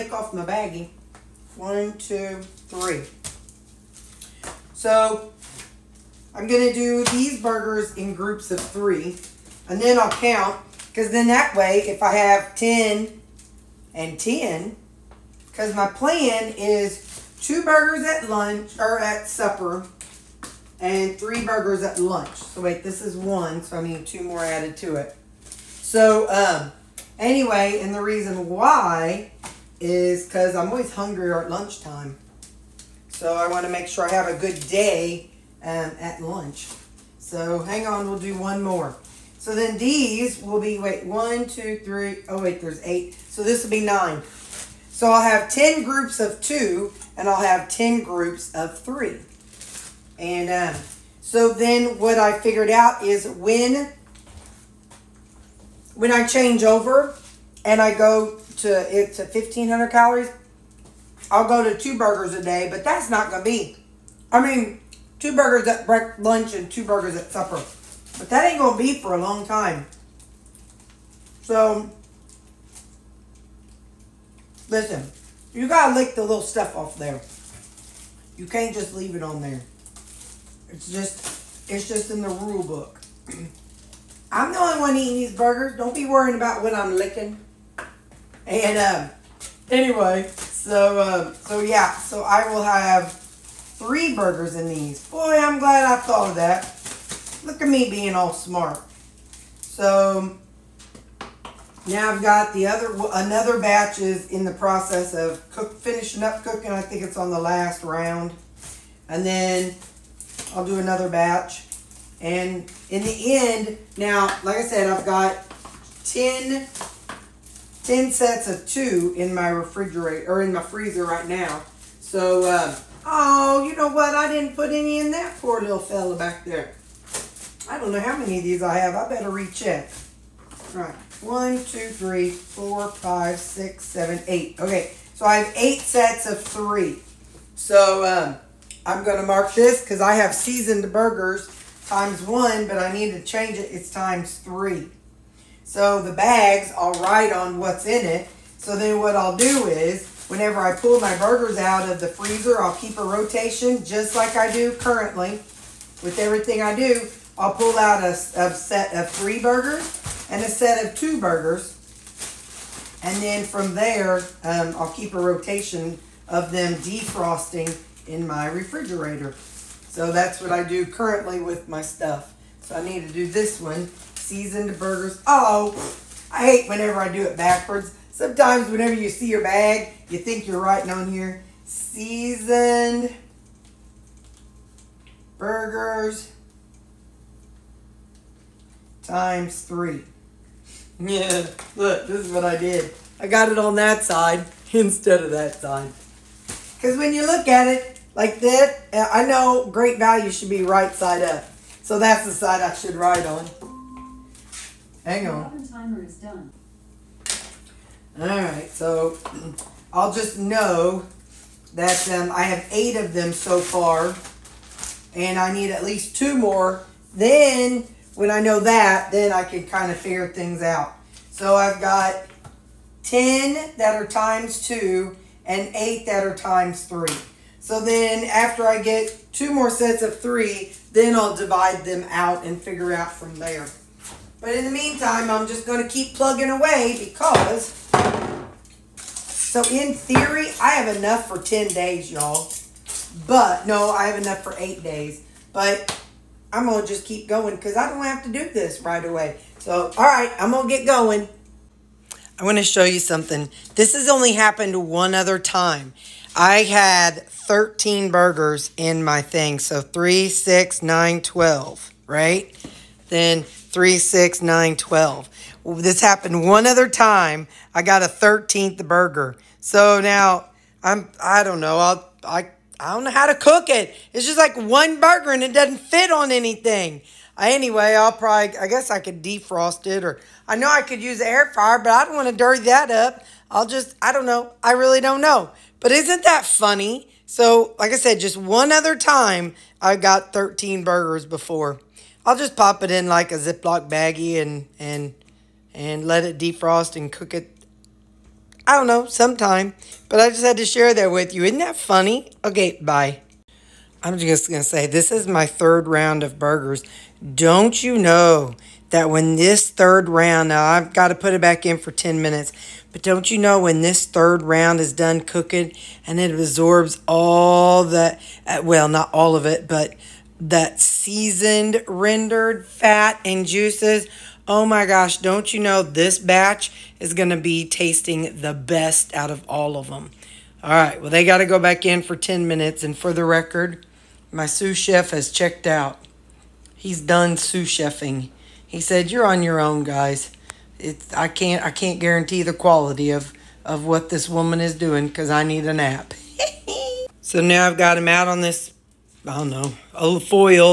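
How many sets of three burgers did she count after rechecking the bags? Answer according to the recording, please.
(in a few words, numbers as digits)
8.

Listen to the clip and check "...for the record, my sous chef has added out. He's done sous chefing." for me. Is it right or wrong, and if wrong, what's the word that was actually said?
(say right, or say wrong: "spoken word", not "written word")
wrong: "checked", not "added".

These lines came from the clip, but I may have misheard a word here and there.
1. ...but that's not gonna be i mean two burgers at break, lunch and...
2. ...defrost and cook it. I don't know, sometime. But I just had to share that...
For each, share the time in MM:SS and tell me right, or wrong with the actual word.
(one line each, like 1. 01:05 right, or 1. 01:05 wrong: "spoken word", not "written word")
1. 01:02 right
2. 04:56 right.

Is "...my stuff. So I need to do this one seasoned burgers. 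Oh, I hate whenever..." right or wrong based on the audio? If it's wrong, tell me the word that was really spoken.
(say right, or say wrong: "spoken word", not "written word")
right.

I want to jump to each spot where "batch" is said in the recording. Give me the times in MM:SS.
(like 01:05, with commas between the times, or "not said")
01:43, 01:51, 05:26.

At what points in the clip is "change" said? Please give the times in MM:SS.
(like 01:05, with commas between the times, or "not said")
00:56, 02:23.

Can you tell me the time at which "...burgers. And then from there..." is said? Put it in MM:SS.
02:41.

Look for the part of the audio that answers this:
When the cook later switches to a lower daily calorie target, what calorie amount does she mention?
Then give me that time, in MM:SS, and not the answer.
00:59.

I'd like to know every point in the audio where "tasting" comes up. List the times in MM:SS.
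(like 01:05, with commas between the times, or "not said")
05:27.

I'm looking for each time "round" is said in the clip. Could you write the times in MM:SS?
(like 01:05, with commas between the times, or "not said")
01:47, 05:05, 05:10, 05:14.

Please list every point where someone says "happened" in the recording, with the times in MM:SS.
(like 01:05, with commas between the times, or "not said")
04:14, 04:26.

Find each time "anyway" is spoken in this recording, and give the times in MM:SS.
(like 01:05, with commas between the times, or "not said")
00:27, 01:29, 04:37.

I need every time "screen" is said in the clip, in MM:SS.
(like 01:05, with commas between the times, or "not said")
not said.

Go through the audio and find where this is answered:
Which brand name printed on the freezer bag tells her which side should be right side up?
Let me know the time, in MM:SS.
03:19.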